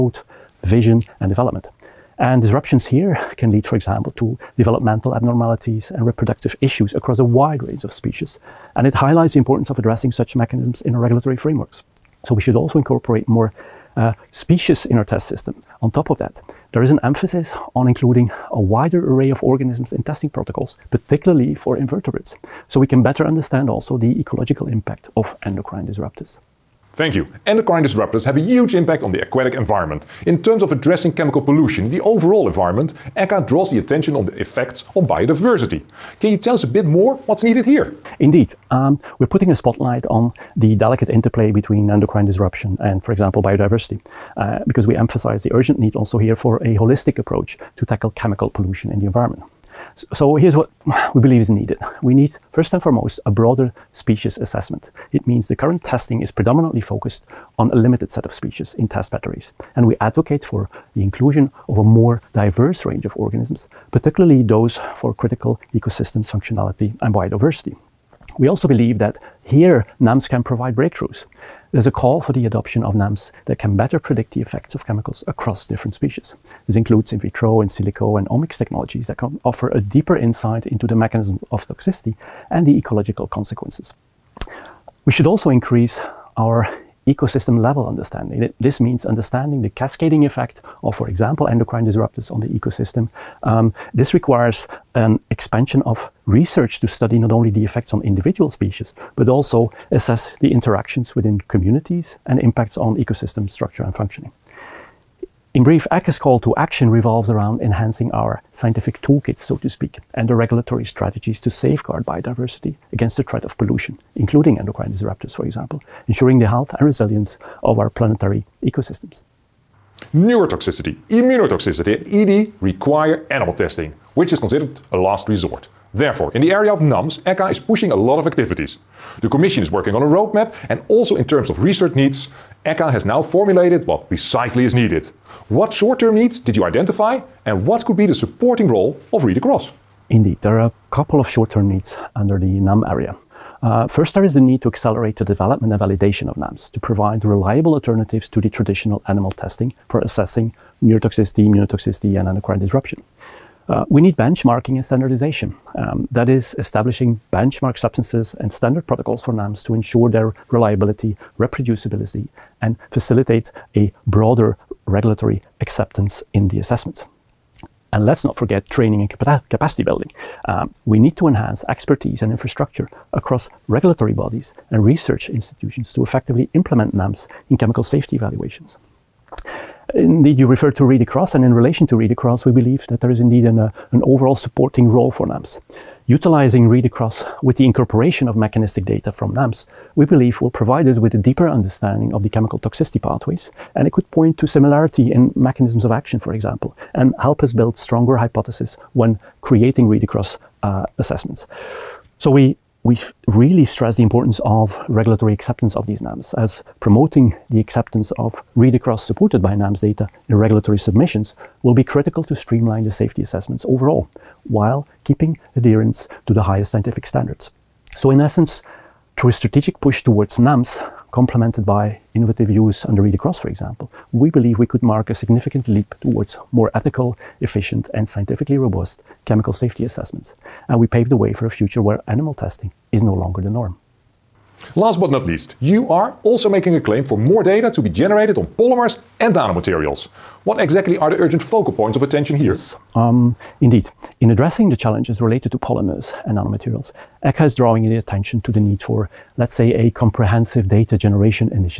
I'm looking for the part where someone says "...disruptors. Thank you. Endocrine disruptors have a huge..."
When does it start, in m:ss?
0:25.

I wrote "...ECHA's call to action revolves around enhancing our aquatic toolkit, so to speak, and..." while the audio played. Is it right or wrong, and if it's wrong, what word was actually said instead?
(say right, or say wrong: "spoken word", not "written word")
wrong: "scientific", not "aquatic".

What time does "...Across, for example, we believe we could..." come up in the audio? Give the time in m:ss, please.
3:43.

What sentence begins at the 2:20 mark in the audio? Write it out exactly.
Indeed, there are couple of short-term needs under the NAM area.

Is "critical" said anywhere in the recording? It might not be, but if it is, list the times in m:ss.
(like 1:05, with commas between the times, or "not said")
1:05, 3:31.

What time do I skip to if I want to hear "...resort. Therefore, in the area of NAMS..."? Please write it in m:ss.
2:05.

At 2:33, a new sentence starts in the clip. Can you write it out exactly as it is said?
Uh, we need benchmarking and standardization.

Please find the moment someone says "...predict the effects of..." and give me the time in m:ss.
1:13.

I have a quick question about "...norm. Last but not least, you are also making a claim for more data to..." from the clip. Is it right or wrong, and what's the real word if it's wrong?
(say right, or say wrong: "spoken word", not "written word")
right.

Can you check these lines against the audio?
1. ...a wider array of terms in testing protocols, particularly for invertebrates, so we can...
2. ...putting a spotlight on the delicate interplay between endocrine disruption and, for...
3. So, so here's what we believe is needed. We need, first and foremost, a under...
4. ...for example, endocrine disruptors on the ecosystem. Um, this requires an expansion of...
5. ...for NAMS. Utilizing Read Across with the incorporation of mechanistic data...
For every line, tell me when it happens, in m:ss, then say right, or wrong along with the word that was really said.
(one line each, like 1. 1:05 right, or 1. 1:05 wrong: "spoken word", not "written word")
1. 0:18 wrong: "organisms", not "terms"
2. 0:39 right
3. 0:49 wrong: "broader", not "under"
4. 1:30 right
5. 3:05 right.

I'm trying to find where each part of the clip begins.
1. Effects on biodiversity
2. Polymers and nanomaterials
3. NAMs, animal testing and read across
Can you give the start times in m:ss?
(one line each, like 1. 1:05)
1. 0:27
2. 3:54
3. 1:59.